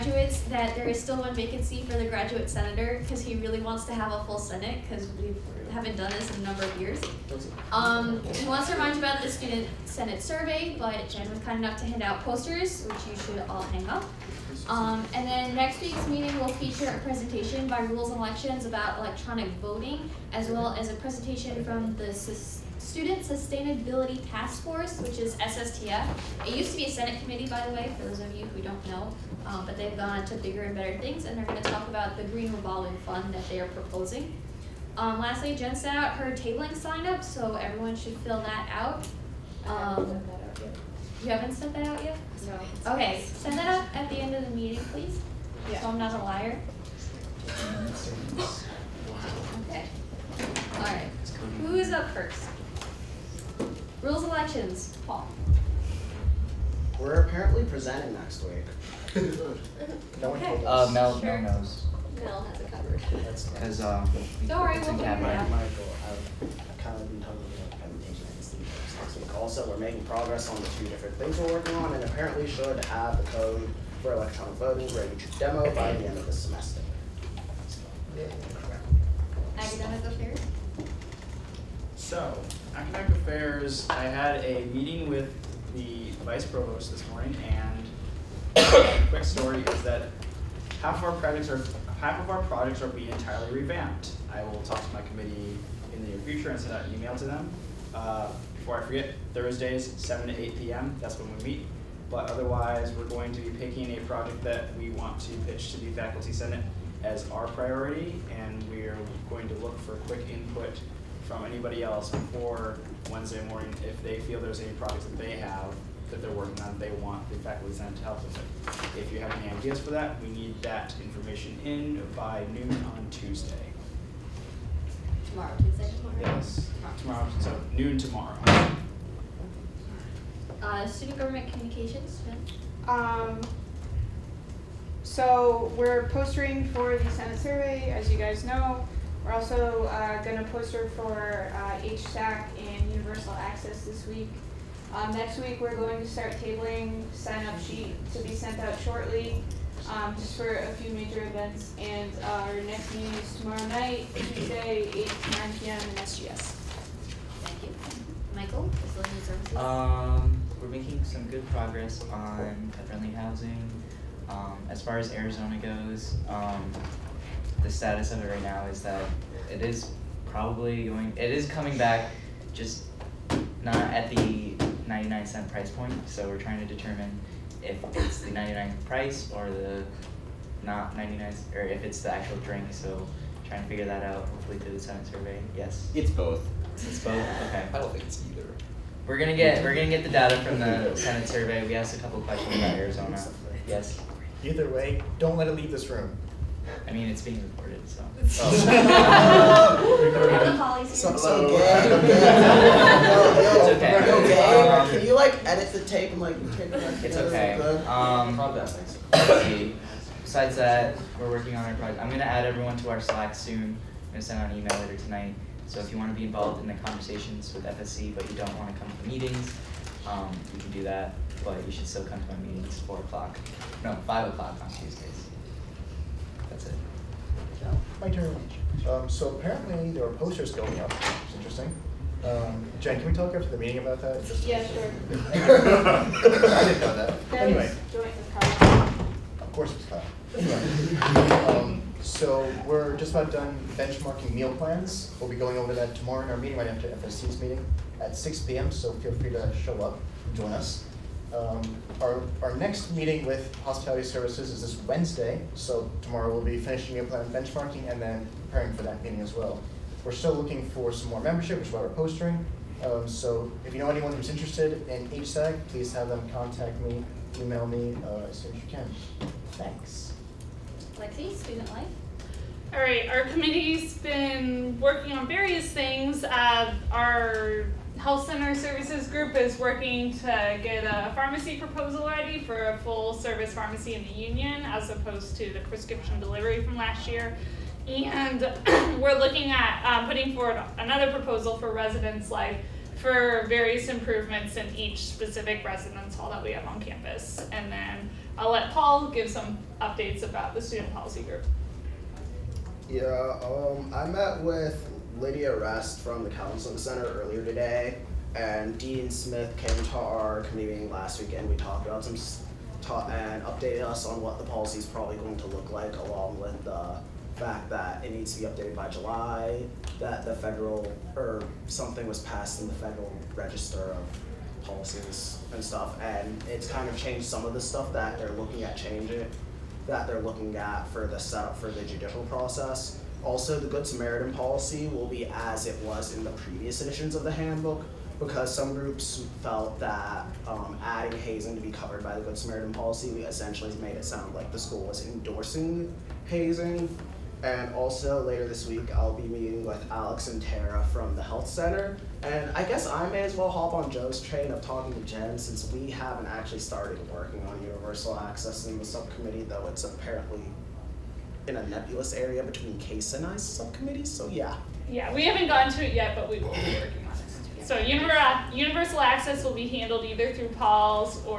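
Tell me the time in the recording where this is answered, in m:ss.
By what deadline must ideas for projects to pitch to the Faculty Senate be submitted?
2:02.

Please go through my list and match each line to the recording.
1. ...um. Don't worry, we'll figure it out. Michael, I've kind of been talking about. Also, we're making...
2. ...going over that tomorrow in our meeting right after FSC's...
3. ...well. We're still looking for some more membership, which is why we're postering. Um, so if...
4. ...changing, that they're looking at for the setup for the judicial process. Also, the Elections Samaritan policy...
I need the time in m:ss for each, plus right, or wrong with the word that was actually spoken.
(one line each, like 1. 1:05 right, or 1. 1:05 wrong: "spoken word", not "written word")
1. 1:03 right
2. 4:05 right
3. 4:19 right
4. 5:28 wrong: "Good", not "Elections".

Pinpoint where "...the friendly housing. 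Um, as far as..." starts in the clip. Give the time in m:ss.
2:42.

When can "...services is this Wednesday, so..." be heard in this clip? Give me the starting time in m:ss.
4:14.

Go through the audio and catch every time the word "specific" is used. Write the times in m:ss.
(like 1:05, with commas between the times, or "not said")
4:55.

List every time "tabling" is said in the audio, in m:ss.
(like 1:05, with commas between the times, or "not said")
0:36, 2:26.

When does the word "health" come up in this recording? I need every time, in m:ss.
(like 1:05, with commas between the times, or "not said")
4:38, 5:51.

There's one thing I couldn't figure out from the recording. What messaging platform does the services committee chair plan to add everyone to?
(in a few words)
Slack.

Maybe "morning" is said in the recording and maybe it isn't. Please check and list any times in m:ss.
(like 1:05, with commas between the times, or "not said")
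1:27, 1:53.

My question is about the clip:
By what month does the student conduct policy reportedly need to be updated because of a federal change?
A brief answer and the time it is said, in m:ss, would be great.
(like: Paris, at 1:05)
July, at 5:18.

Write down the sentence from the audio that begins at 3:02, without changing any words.
So trying to figure that out, hopefully through the Senate survey.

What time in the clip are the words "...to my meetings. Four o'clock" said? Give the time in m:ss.
3:42.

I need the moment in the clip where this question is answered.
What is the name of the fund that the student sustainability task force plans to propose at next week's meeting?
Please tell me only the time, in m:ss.
0:32.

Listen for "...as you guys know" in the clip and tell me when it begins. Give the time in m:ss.
2:17.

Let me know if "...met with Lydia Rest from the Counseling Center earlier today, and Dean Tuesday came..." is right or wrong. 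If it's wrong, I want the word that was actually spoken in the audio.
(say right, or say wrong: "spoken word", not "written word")
wrong: "Smith", not "Tuesday".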